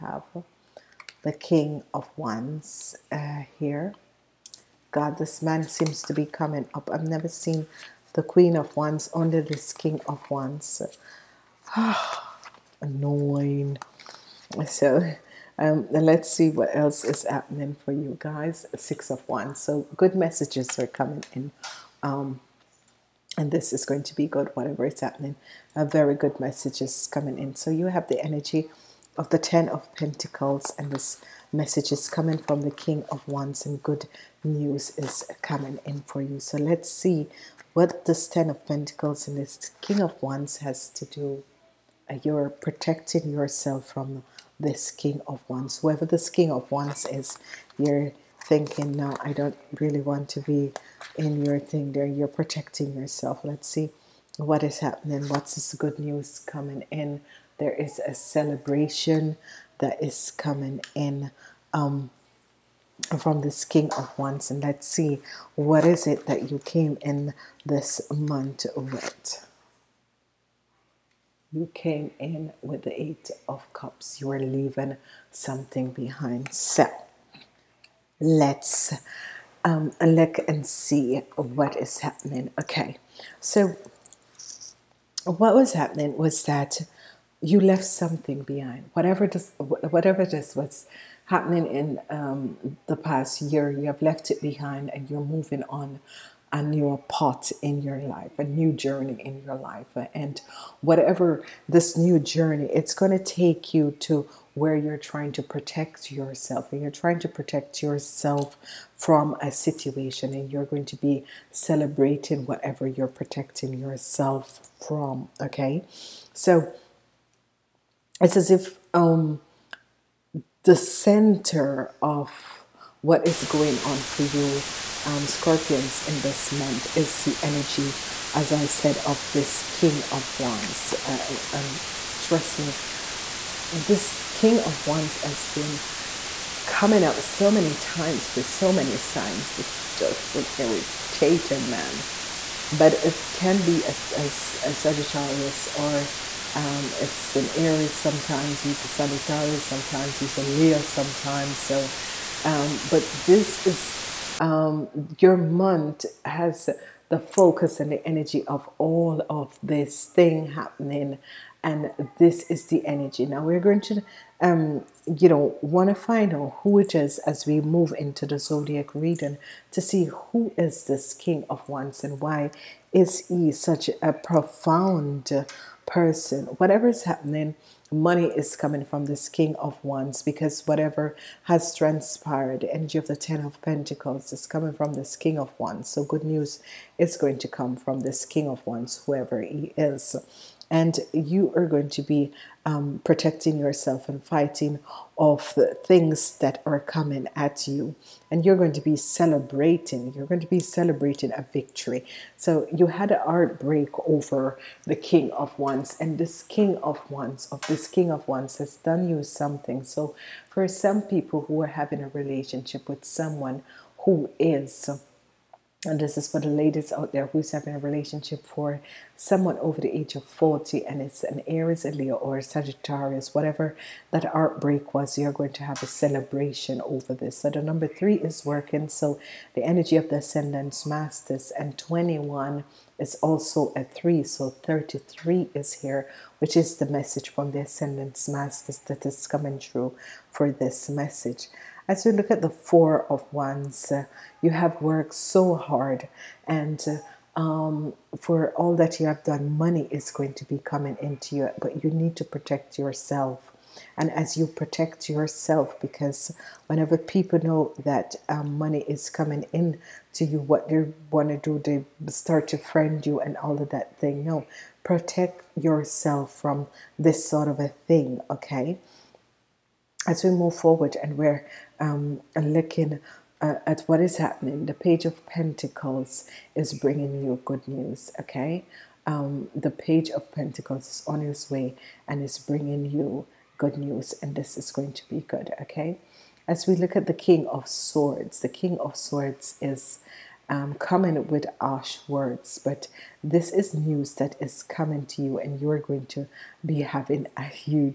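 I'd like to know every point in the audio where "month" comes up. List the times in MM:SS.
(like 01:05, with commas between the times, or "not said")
01:08, 02:06, 02:35.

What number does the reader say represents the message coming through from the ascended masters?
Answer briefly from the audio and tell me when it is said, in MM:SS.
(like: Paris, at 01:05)
33, at 03:54.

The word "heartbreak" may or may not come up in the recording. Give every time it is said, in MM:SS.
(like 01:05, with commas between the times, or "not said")
03:23, 03:44.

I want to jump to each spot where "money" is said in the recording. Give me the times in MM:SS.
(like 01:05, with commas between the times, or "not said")
02:57, 04:09, 04:18.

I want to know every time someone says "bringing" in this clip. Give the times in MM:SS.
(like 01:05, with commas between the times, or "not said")
04:36, 04:42.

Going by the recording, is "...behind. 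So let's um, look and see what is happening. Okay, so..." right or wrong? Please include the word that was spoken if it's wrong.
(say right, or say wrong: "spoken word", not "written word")
right.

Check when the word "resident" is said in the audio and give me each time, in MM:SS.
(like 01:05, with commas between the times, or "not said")
not said.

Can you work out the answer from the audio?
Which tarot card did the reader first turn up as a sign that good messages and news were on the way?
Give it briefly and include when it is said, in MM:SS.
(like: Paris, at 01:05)
Six of Wands, at 00:18.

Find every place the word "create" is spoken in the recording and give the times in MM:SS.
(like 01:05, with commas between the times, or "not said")
not said.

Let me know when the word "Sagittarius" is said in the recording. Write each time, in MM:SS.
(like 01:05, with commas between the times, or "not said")
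02:24, 02:28, 03:42.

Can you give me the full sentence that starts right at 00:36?
So let's see what this Ten of Pentacles and this King of Wands has to do.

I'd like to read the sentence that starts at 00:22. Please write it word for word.
Um, and this is going to be good, whatever is happening.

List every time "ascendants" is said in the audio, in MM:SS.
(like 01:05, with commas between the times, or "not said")
03:50, 03:57.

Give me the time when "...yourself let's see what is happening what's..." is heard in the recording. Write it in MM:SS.
00:52.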